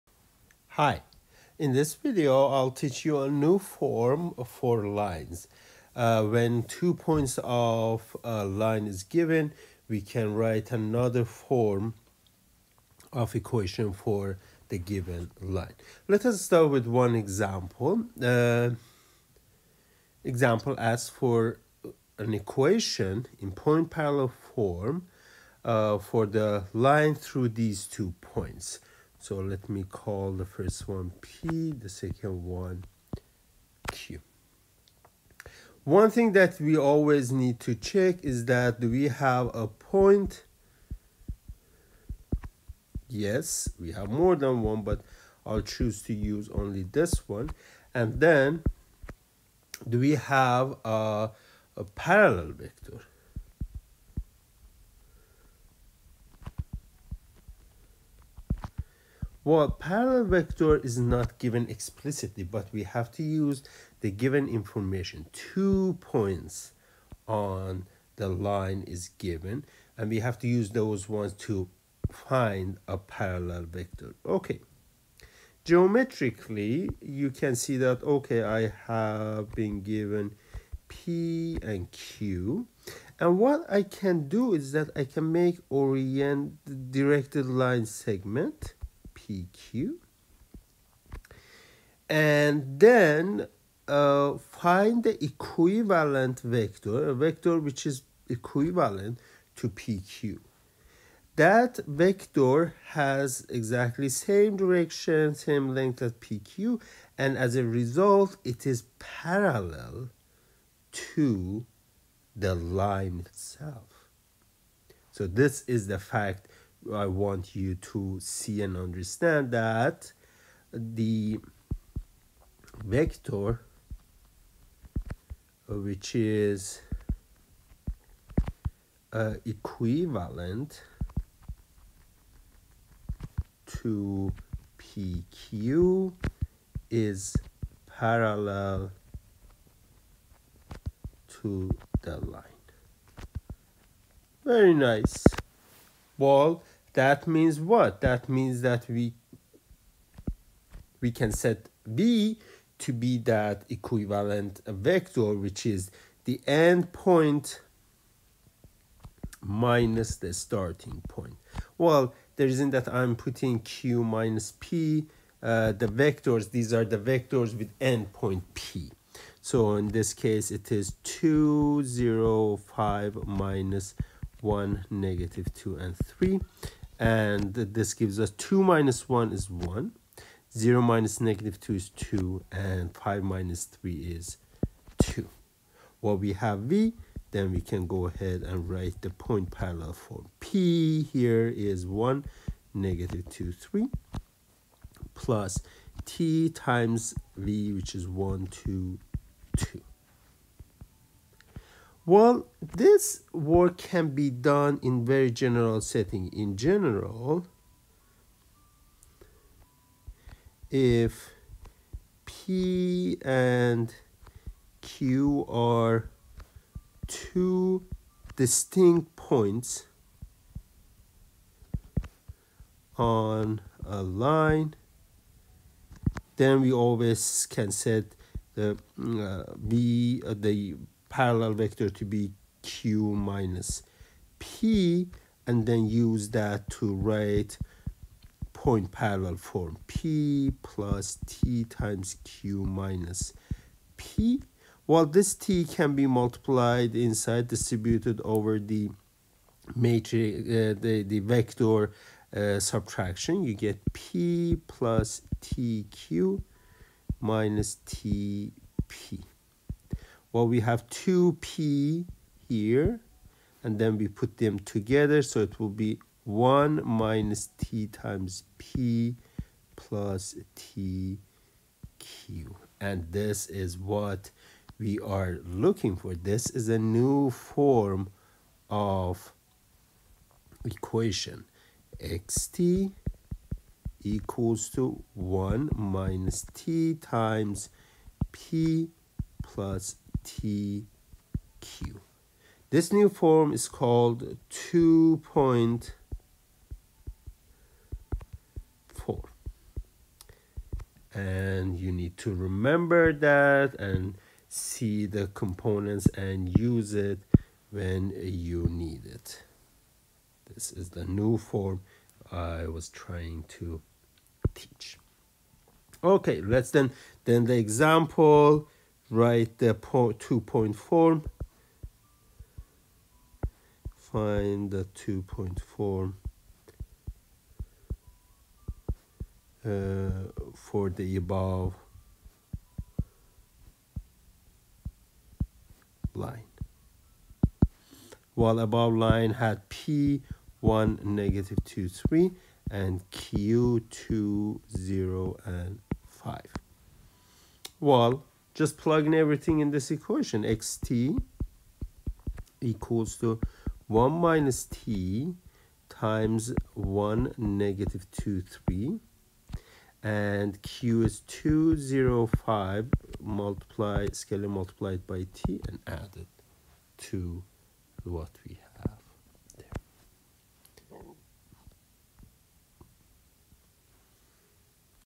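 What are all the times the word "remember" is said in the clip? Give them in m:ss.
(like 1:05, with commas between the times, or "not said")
5:02.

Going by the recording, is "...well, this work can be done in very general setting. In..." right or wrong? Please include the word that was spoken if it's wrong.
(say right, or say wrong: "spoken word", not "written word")
right.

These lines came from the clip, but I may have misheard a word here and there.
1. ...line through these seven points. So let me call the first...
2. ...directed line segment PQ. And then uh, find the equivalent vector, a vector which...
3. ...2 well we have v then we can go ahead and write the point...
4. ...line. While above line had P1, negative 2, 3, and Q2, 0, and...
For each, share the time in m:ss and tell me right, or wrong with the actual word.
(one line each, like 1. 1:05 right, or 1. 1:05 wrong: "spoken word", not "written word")
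1. 0:26 wrong: "two", not "seven"
2. 1:26 right
3. 3:05 right
4. 5:36 right.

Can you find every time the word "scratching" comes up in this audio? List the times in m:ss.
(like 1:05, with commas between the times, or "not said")
not said.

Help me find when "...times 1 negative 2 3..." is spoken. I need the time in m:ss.
5:55.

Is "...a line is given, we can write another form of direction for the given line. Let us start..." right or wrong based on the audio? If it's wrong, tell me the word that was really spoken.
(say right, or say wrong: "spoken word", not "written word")
wrong: "equation", not "direction".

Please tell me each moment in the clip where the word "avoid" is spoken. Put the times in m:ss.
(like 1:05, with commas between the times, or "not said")
not said.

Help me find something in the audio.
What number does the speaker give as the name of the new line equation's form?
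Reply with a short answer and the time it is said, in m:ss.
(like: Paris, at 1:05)
2.4, at 4:54.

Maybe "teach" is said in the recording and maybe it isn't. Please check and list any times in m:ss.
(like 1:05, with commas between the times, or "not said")
0:02, 5:14.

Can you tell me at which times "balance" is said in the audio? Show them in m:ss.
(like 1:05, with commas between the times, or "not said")
not said.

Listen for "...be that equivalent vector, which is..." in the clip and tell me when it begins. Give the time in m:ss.
2:32.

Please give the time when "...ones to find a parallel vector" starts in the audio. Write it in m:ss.
1:11.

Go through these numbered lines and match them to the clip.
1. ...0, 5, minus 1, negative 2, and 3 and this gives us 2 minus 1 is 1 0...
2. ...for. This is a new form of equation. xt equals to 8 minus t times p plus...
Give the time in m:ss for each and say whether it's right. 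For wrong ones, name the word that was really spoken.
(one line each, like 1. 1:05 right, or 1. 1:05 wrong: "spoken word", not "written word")
1. 2:51 right
2. 4:35 wrong: "1", not "8".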